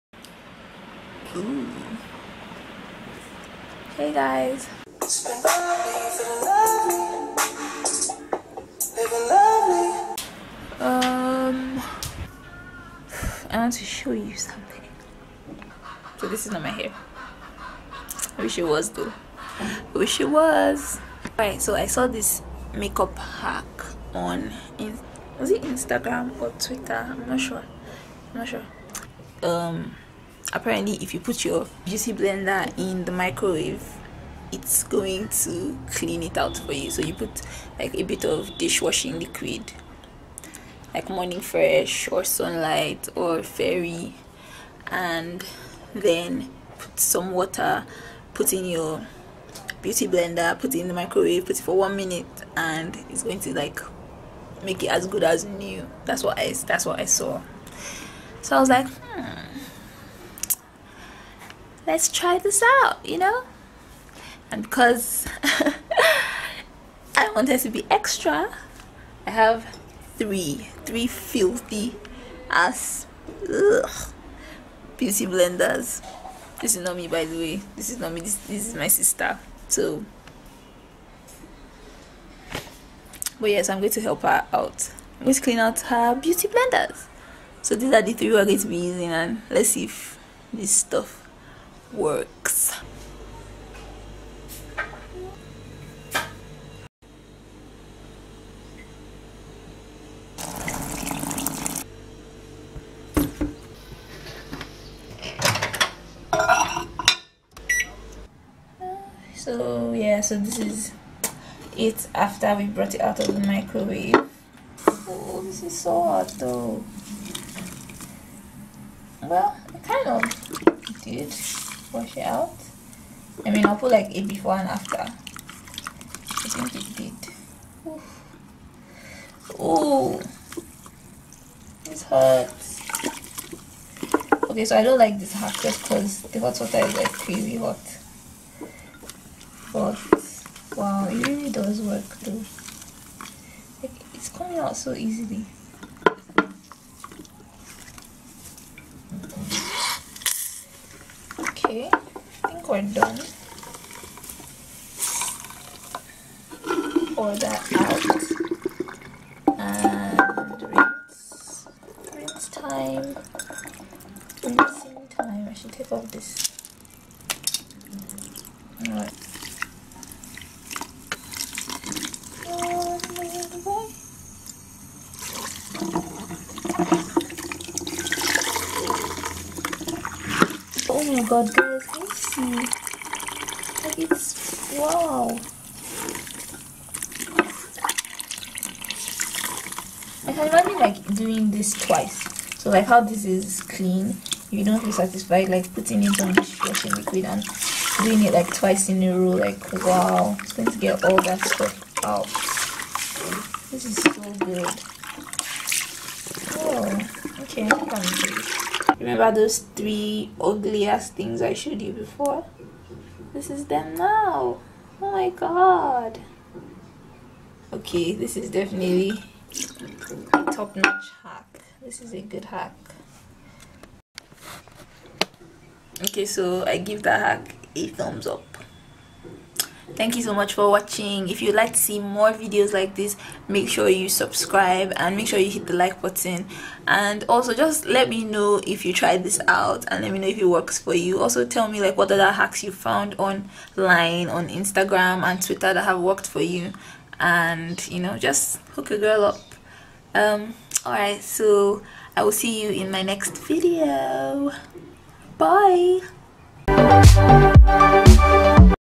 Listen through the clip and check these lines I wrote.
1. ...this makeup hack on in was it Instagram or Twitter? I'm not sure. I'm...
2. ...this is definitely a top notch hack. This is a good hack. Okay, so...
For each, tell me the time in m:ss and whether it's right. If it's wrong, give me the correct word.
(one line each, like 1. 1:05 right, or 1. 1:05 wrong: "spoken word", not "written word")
1. 0:22 right
2. 3:38 right.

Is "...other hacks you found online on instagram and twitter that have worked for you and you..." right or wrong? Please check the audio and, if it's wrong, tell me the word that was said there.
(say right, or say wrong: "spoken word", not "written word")
right.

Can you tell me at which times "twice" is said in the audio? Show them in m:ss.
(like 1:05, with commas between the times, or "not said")
3:11, 3:18.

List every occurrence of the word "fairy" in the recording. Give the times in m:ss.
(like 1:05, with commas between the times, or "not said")
0:43.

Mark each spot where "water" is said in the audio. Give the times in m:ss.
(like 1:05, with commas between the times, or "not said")
0:47, 2:16.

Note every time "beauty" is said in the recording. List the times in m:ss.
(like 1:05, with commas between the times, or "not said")
0:31, 0:49, 1:14, 1:26.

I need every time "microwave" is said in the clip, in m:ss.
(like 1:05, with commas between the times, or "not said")
0:33, 0:50, 1:53.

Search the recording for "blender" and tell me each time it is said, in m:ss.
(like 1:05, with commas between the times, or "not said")
0:32, 0:50, 1:15, 1:26.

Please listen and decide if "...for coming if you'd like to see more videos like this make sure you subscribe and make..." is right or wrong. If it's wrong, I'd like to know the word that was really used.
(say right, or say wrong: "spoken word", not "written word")
wrong: "watching", not "coming".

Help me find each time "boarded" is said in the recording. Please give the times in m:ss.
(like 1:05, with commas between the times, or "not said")
not said.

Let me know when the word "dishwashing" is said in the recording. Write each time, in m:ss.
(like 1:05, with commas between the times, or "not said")
0:38, 3:16.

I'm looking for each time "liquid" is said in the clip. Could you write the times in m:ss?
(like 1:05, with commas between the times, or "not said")
0:39, 3:16.